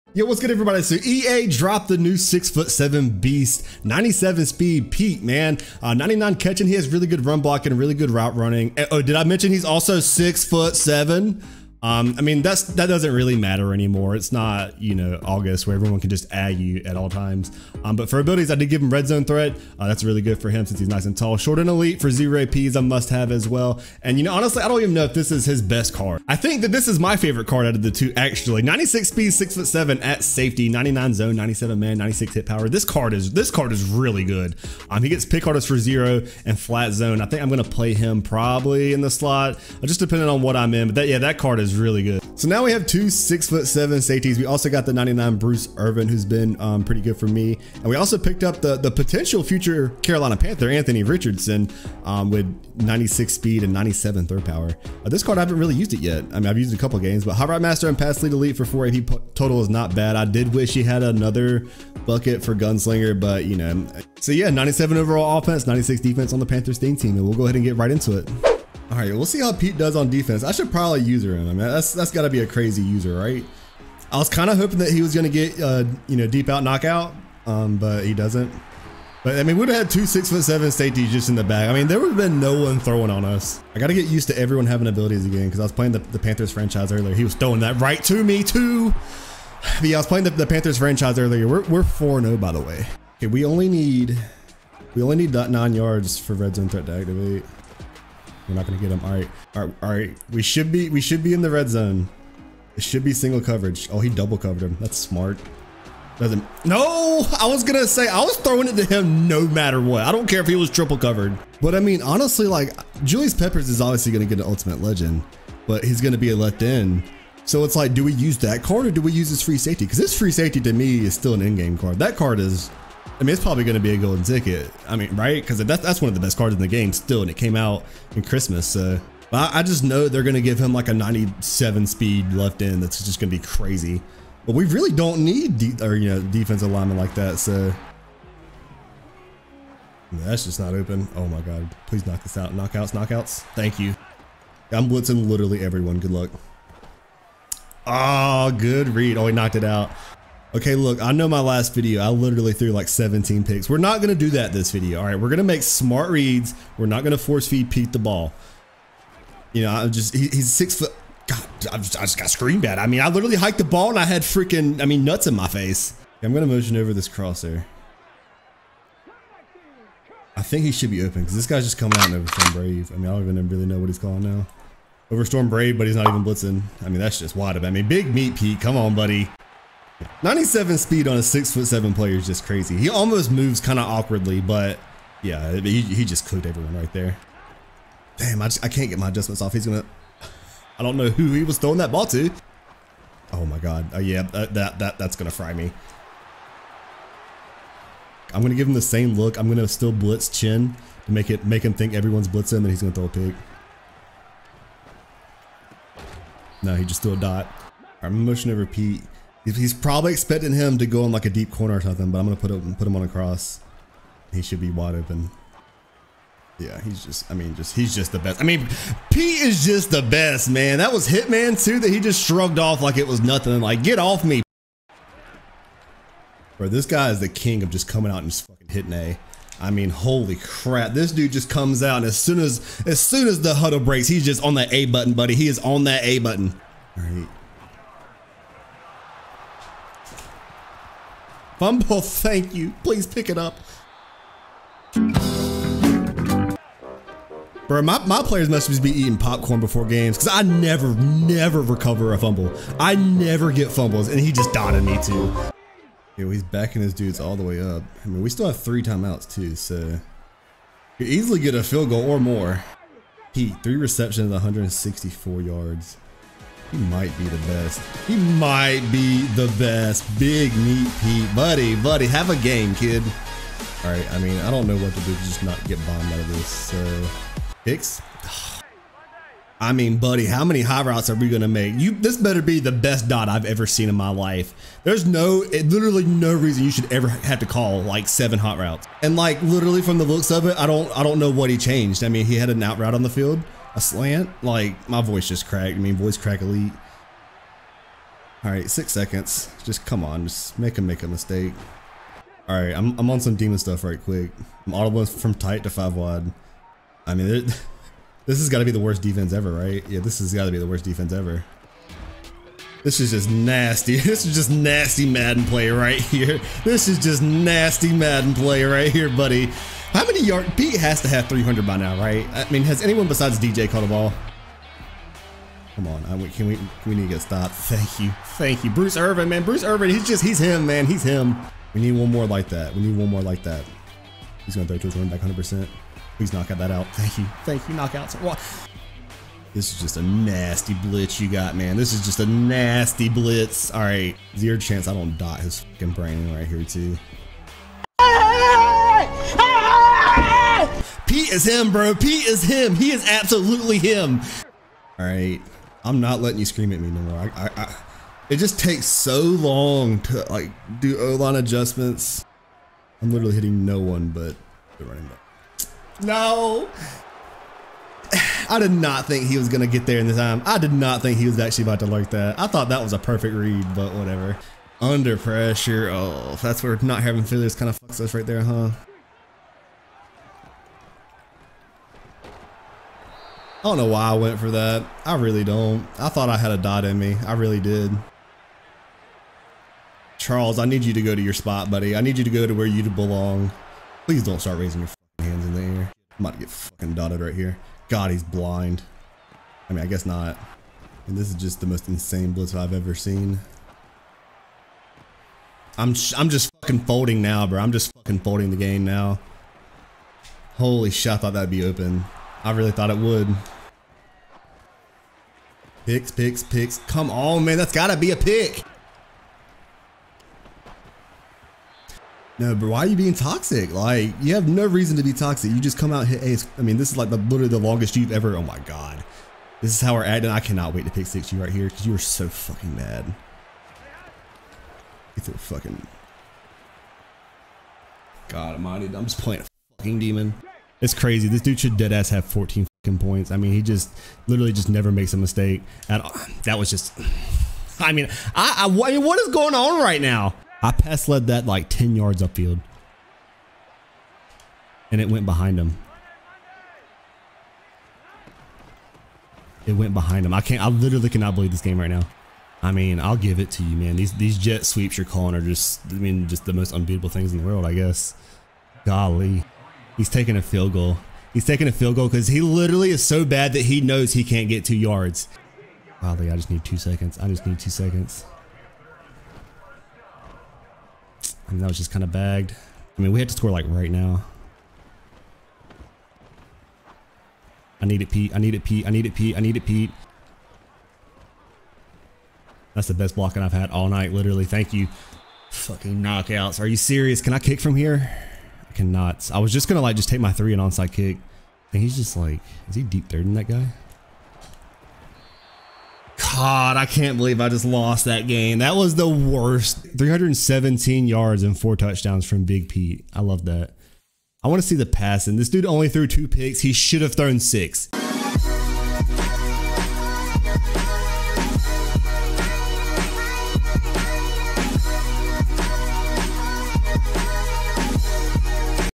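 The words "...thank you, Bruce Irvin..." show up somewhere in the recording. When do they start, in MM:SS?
05:28.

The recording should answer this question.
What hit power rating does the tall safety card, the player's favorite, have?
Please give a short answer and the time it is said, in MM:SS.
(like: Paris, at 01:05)
96, at 00:31.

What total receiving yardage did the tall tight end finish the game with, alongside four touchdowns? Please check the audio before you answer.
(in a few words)
317.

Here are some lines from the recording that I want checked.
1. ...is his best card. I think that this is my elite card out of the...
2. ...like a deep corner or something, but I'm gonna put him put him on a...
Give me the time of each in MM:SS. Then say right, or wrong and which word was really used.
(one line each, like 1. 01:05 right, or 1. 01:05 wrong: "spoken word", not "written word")
1. 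00:25 wrong: "favorite", not "elite"
2. 03:31 right.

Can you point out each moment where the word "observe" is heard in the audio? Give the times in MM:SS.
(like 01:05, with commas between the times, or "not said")
not said.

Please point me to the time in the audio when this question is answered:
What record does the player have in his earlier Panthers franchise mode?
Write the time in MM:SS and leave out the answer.
01:31.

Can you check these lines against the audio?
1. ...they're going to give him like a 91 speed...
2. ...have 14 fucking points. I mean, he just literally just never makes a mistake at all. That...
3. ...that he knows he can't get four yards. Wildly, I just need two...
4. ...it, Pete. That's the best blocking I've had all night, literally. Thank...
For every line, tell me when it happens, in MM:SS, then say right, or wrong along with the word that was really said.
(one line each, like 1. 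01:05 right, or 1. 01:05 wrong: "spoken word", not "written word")
1. 02:10 wrong: "97", not "91"
2. 07:22 right
3. 07:53 wrong: "two", not "four"
4. 08:09 right.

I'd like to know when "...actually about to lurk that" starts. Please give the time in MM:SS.
06:11.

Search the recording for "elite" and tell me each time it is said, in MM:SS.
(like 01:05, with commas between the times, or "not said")
00:21, 00:58, 04:56.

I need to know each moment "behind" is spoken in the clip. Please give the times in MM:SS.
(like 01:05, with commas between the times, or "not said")
07:35, 07:39.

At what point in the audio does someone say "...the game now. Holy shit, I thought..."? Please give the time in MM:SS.
06:48.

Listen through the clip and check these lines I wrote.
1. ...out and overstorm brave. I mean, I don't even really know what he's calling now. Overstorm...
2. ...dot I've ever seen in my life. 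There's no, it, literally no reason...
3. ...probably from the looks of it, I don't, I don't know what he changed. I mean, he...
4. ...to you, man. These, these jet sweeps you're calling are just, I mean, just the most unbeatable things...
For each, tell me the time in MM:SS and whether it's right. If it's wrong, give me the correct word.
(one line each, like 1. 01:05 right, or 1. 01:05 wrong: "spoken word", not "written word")
1. 02:51 right
2. 04:43 right
3. 04:49 wrong: "literally", not "probably"
4. 07:43 right.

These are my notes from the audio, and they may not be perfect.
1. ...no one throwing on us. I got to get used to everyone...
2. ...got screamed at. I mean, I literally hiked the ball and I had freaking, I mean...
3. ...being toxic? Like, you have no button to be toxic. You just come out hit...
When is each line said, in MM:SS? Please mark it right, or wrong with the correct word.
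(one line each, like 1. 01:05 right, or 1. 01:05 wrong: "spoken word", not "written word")
1. 01:22 right
2. 02:42 right
3. 07:02 wrong: "reason", not "button".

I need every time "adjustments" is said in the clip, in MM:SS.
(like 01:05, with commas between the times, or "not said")
03:09, 06:01.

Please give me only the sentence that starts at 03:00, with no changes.
97 speed on a six foot seven player is just crazy.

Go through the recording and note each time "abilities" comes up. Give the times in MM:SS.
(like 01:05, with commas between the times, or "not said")
00:18, 01:24.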